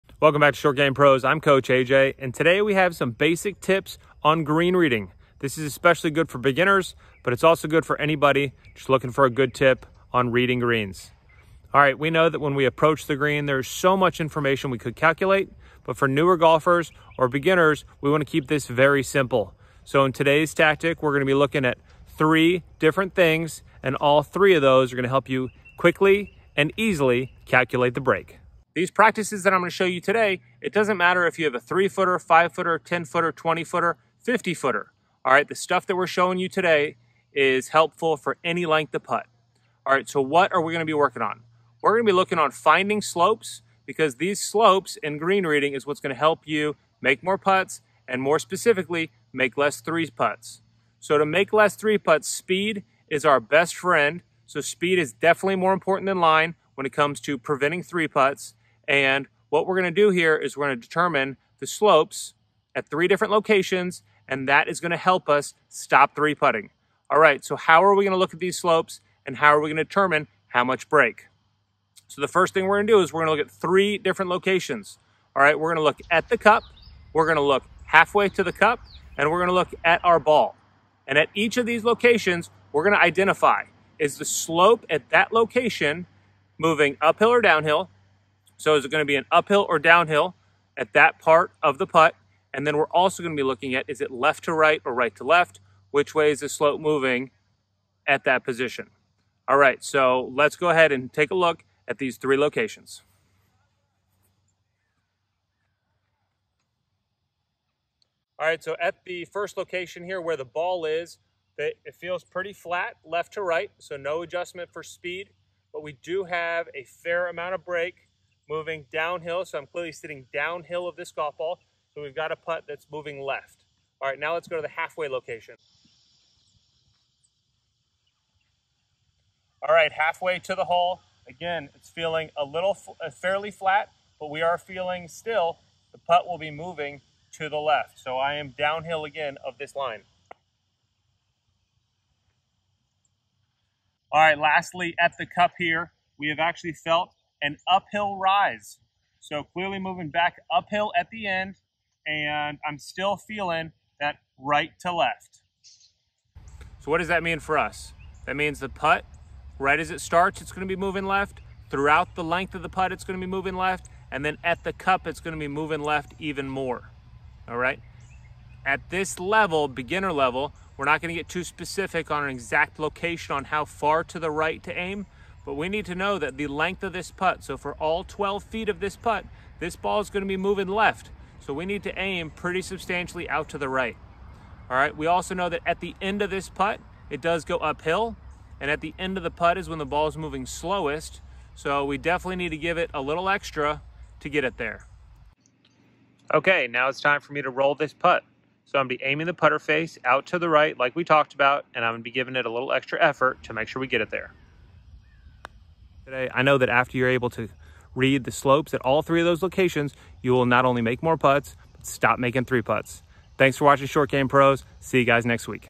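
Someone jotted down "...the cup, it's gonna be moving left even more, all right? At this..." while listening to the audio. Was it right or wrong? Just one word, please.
right.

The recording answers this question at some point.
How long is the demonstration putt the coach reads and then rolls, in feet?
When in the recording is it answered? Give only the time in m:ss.
2:58.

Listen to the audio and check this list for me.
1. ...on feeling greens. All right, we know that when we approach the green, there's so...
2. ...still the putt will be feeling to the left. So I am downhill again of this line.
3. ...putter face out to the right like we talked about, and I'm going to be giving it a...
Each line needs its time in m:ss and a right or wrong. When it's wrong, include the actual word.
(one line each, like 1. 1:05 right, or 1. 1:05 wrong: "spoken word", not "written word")
1. 0:10 wrong: "reading", not "feeling"
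2. 2:15 wrong: "moving", not "feeling"
3. 3:19 right.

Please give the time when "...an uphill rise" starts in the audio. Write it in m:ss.
2:27.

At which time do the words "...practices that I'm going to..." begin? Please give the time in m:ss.
0:28.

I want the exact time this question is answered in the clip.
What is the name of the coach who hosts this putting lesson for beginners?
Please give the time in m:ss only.
0:01.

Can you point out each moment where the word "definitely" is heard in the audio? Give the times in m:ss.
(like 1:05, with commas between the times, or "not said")
0:55, 3:11.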